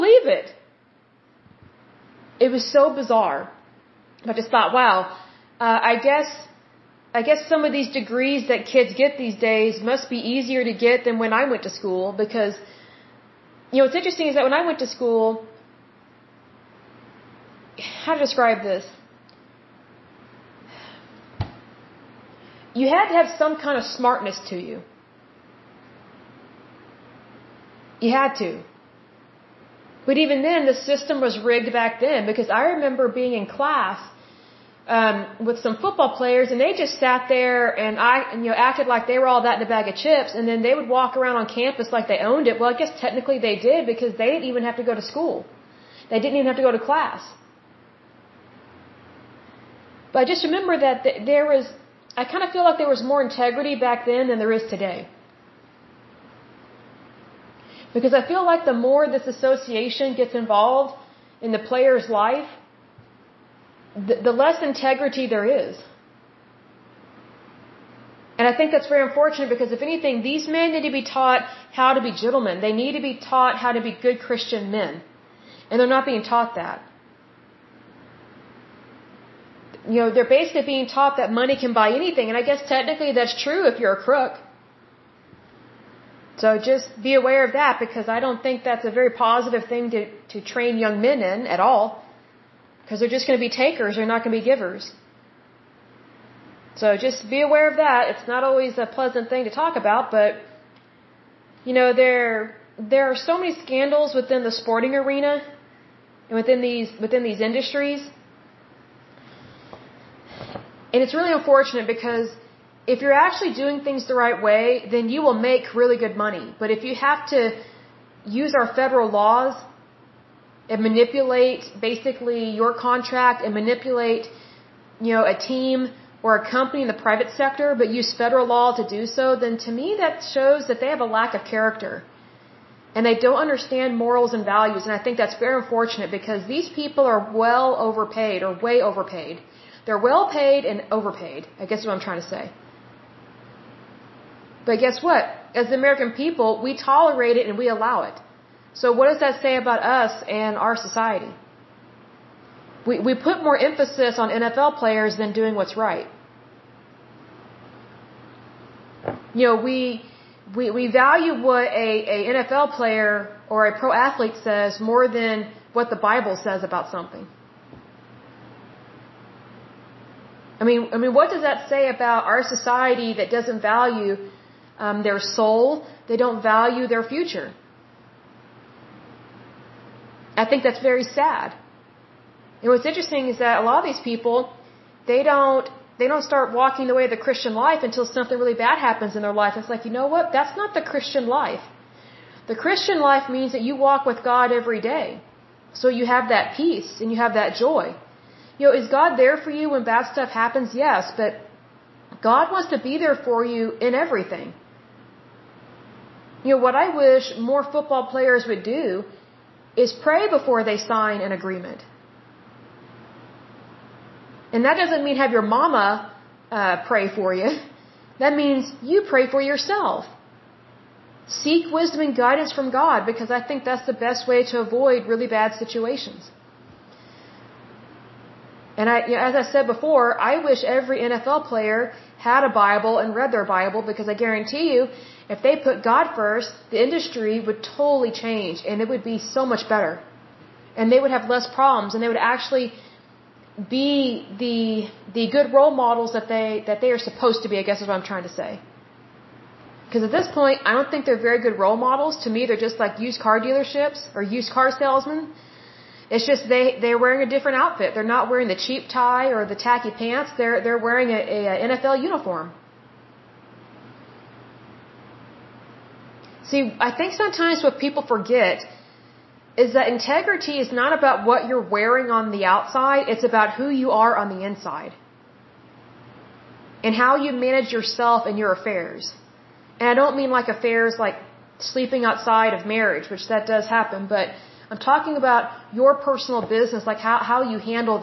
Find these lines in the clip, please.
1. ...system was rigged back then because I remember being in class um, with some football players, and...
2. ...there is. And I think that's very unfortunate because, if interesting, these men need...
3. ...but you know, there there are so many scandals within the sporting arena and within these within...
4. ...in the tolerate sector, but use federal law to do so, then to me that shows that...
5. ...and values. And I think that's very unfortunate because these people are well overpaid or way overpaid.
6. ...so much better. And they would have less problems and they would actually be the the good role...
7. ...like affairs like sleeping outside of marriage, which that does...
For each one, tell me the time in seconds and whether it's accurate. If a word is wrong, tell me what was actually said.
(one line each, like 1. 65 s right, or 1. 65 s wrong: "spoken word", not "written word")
1. 30 s right
2. 65 s wrong: "anything", not "interesting"
3. 100 s right
4. 126 s wrong: "private", not "tolerate"
5. 134 s right
6. 239 s right
7. 280 s right.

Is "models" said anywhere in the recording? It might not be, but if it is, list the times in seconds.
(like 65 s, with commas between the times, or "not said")
245 s, 251 s.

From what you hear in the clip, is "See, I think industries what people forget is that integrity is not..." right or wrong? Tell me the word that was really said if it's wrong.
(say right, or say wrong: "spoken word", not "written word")
wrong: "sometimes", not "industries".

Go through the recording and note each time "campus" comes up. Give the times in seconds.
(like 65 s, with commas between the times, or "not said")
41 s.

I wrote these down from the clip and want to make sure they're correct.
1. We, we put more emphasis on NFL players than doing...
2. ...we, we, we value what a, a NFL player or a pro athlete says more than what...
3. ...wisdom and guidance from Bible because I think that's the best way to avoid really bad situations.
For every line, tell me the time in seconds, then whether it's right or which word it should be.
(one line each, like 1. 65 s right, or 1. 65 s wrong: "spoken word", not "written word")
1. 152 s right
2. 159 s right
3. 221 s wrong: "God", not "Bible".